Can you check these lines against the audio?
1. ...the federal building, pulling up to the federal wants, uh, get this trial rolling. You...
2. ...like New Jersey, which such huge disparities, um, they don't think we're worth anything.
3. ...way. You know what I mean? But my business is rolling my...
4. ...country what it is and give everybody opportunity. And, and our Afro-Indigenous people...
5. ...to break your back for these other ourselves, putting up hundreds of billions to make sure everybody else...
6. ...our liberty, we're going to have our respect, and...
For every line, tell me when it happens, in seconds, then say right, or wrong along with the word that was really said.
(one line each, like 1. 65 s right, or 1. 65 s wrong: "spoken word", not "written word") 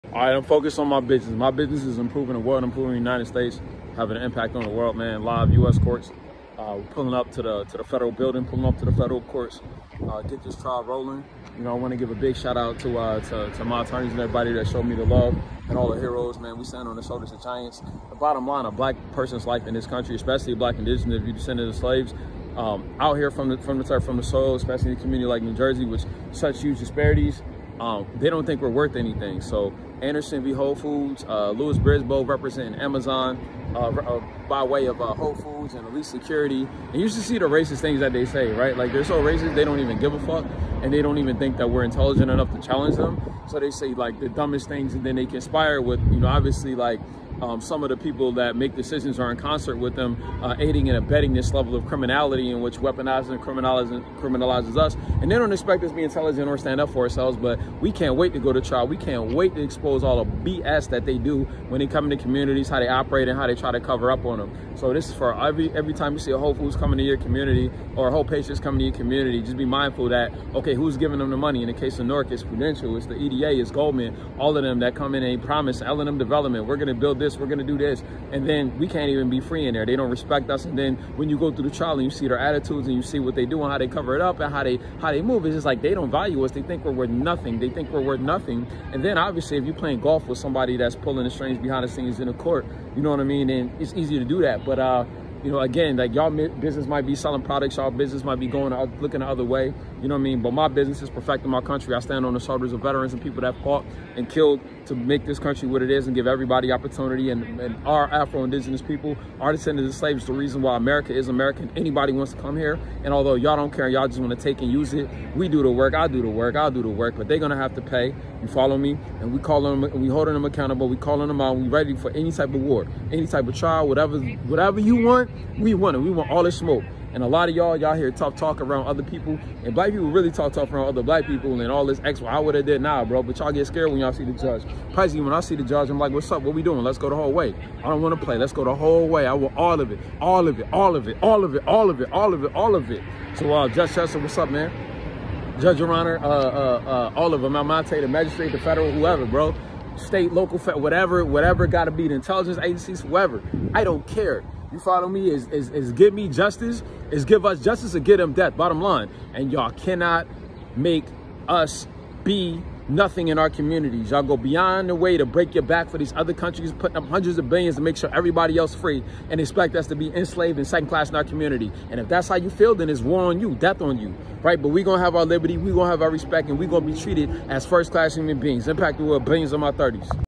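1. 7 s wrong: "courts", not "wants"
2. 25 s right
3. 99 s wrong: "perfecting", not "rolling"
4. 105 s right
5. 165 s wrong: "countries", not "ourselves"
6. 175 s right.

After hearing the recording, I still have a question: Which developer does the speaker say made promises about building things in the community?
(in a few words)
L&M development.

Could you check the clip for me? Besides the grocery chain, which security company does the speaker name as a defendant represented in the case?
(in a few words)
Elite Security.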